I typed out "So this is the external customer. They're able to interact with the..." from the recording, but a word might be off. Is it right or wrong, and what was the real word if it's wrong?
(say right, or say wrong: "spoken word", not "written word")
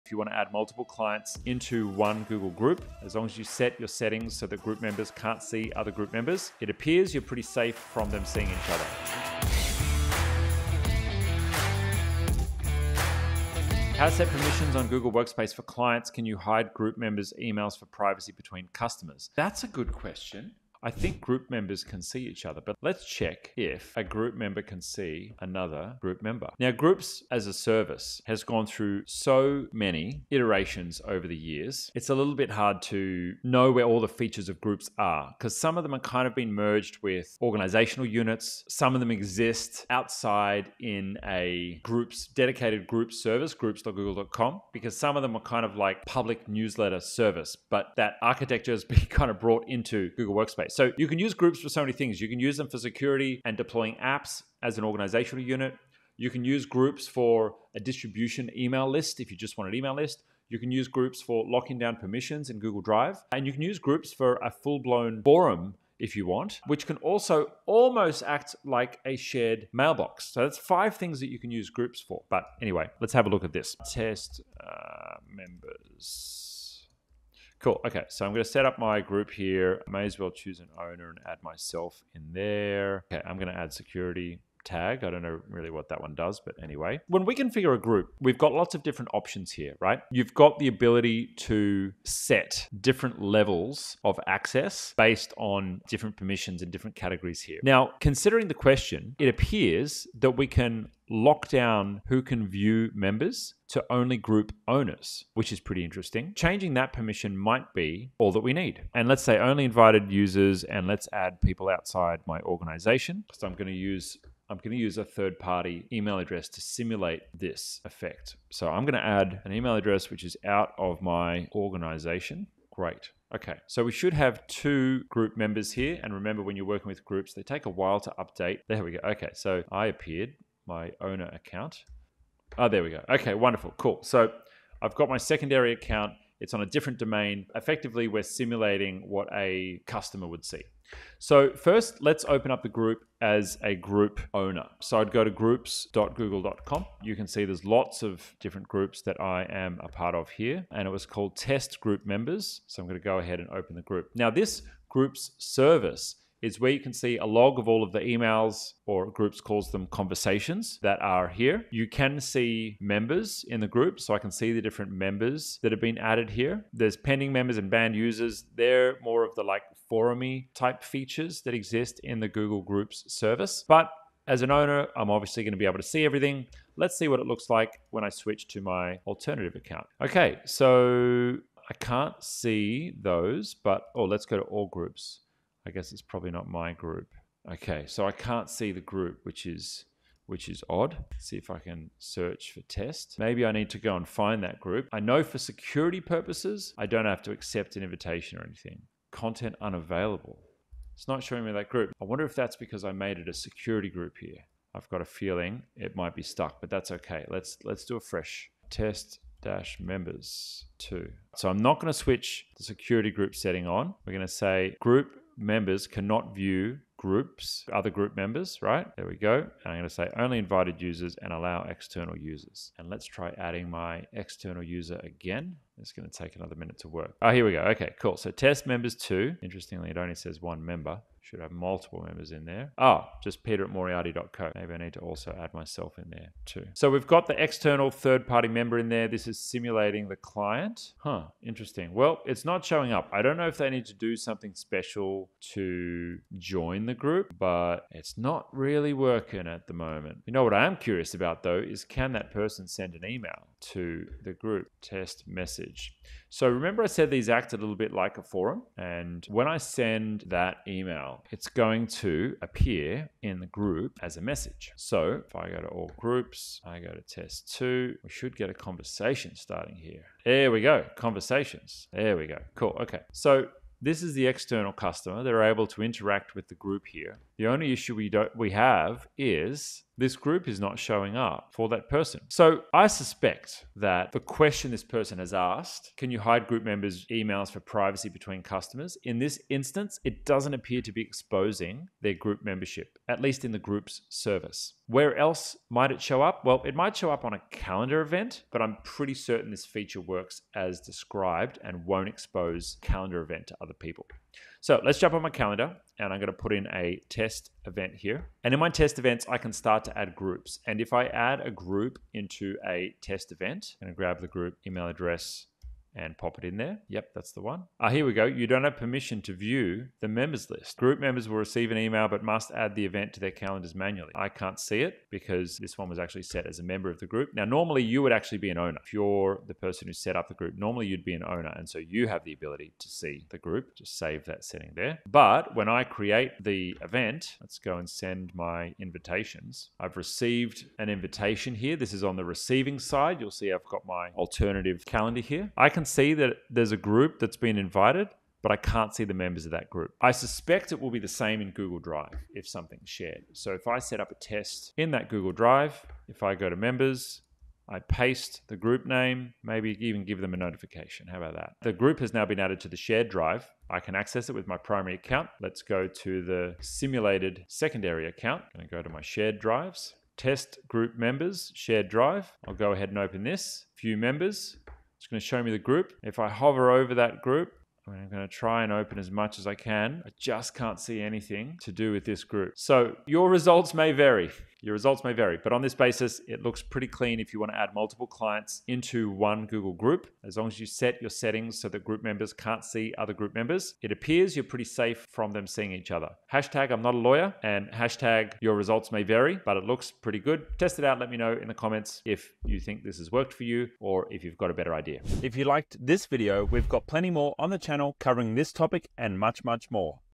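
right.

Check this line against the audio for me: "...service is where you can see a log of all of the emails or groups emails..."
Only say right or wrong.
wrong.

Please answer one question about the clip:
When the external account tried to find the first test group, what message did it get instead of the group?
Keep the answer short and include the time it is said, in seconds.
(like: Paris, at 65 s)
Content unavailable, at 199 s.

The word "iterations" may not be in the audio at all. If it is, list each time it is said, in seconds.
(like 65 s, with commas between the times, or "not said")
30 s.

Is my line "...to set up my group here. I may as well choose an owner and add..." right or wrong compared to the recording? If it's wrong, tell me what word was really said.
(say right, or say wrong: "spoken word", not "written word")
right.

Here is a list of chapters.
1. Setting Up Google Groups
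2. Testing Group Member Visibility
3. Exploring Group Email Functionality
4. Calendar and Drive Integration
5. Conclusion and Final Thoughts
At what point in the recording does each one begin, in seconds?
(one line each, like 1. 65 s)
1. 78 s
2. 141 s
3. 253 s
4. 296 s
5. 387 s.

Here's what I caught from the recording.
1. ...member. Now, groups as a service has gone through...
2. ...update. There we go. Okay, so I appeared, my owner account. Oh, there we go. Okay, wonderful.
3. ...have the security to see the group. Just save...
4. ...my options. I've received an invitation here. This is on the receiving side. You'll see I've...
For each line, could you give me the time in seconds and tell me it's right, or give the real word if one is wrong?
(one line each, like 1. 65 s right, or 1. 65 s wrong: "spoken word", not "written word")
1. 26 s right
2. 128 s right
3. 332 s wrong: "ability", not "security"
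4. 338 s wrong: "invitations", not "options".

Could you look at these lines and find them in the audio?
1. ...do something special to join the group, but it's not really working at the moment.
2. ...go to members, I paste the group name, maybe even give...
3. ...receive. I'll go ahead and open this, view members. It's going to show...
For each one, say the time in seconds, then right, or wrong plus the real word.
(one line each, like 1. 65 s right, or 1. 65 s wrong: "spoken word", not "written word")
1. 243 s right
2. 356 s right
3. 371 s wrong: "drive", not "receive".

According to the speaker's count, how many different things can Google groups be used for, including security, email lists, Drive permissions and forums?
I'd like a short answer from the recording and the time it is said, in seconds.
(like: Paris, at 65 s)
5, at 70 s.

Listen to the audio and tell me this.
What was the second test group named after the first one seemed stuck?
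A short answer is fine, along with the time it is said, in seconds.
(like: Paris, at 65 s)
test-members-2, at 208 s.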